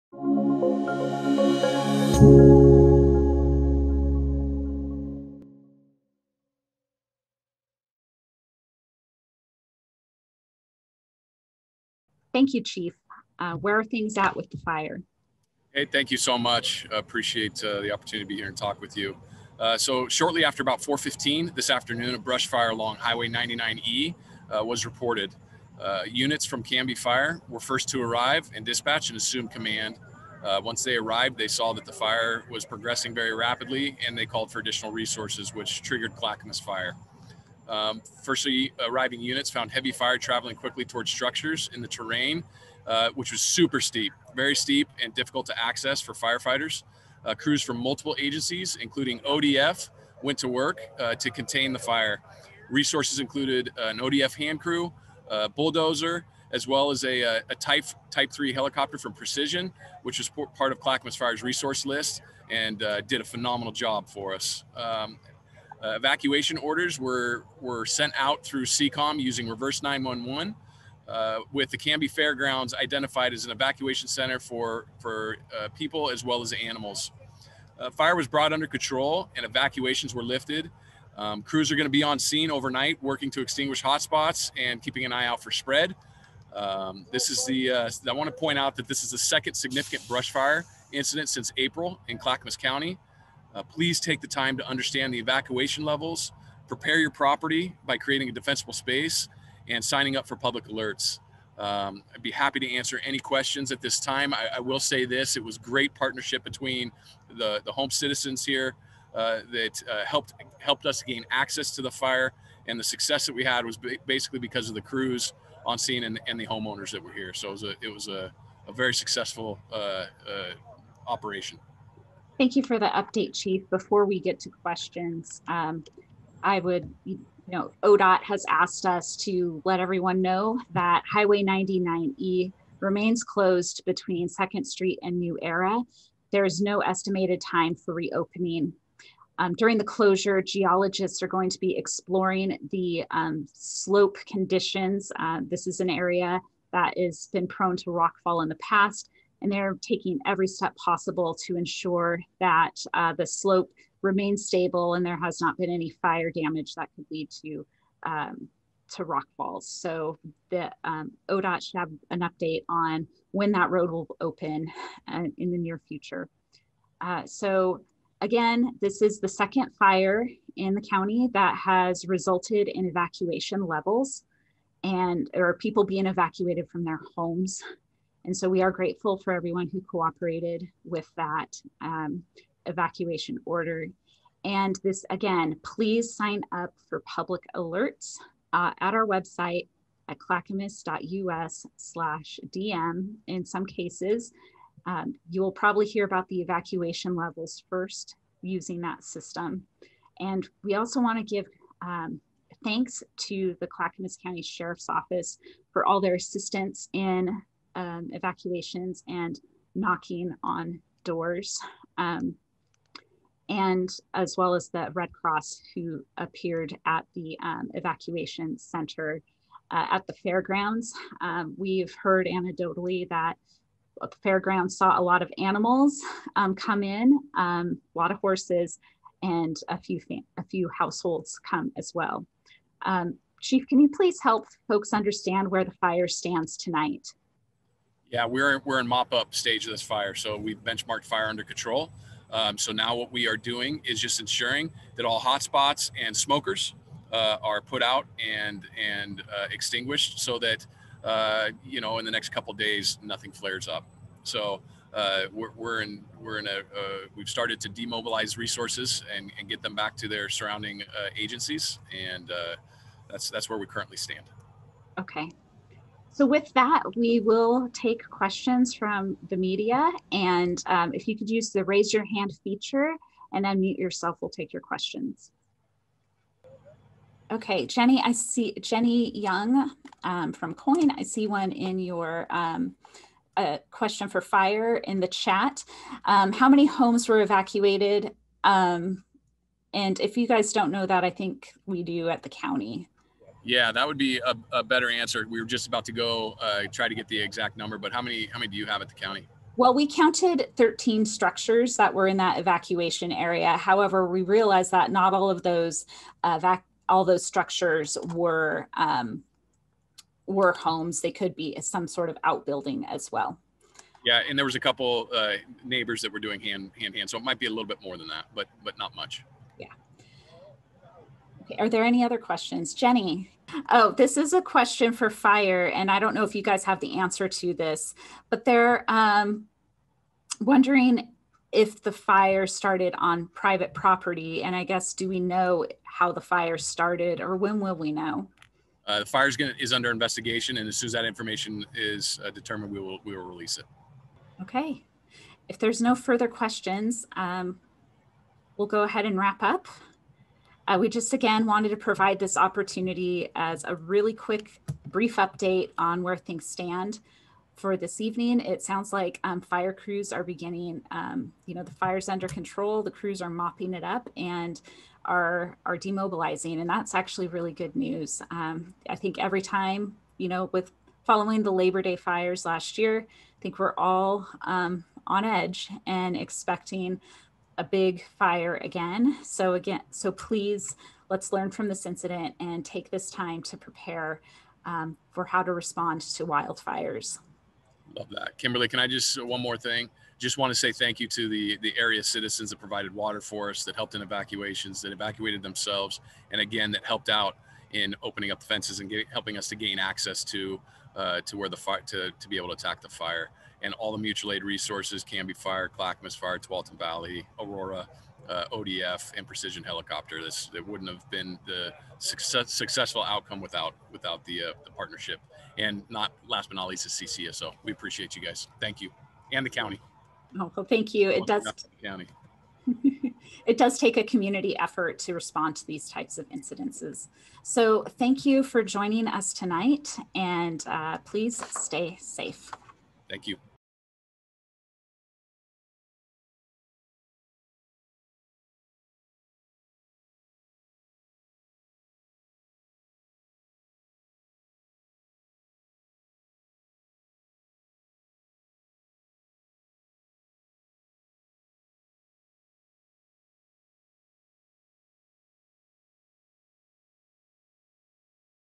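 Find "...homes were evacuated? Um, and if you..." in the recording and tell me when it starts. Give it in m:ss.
4:46.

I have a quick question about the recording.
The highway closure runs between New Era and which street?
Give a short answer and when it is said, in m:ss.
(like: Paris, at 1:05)
2nd Street, at 2:14.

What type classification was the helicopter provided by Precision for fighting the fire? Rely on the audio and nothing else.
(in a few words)
Type 3.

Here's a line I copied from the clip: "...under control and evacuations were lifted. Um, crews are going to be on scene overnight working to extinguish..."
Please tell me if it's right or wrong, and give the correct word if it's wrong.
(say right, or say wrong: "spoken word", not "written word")
right.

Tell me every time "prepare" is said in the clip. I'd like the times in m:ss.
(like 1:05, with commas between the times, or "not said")
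1:36, 6:23.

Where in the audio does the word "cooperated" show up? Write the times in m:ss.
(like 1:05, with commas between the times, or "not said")
2:59.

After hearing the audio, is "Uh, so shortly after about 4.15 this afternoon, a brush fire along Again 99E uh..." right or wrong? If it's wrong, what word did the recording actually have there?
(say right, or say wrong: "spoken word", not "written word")
wrong: "Highway", not "Again".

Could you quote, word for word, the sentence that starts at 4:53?
Yeah, that would be a, a better answer.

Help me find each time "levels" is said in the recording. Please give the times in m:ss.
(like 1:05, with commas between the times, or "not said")
1:35, 2:53, 3:17.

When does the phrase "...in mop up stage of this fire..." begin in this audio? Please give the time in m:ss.
3:58.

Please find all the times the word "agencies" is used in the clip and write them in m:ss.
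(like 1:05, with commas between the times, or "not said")
0:48, 4:21.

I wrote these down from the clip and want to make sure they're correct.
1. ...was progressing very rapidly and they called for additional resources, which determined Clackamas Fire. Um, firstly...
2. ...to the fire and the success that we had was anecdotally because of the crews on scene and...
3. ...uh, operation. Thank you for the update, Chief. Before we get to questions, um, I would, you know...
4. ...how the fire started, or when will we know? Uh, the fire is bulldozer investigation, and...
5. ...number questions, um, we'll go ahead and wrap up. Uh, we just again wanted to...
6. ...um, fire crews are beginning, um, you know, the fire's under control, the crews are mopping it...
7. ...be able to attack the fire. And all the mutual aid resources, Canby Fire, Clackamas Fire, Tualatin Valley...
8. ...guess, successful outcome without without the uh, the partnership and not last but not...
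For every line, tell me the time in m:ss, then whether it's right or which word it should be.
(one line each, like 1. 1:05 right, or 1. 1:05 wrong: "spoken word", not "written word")
1. 0:32 wrong: "triggered", not "determined"
2. 1:51 wrong: "basically", not "anecdotally"
3. 2:00 right
4. 5:35 wrong: "under", not "bulldozer"
5. 5:45 wrong: "further", not "number"
6. 5:59 right
7. 6:42 right
8. 6:51 wrong: "success", not "guess".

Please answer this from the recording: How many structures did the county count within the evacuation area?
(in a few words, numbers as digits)
13.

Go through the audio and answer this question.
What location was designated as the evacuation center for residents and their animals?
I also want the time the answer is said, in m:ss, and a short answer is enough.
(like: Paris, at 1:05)
Canby Fairgrounds, at 1:11.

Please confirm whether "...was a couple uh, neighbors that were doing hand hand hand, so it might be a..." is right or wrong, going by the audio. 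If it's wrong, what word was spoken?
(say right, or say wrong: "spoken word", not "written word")
right.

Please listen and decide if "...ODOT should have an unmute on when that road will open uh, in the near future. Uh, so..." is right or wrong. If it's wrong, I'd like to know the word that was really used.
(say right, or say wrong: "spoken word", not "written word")
wrong: "update", not "unmute".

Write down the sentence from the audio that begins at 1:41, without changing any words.
Um, I'd be happy to answer any questions at this time.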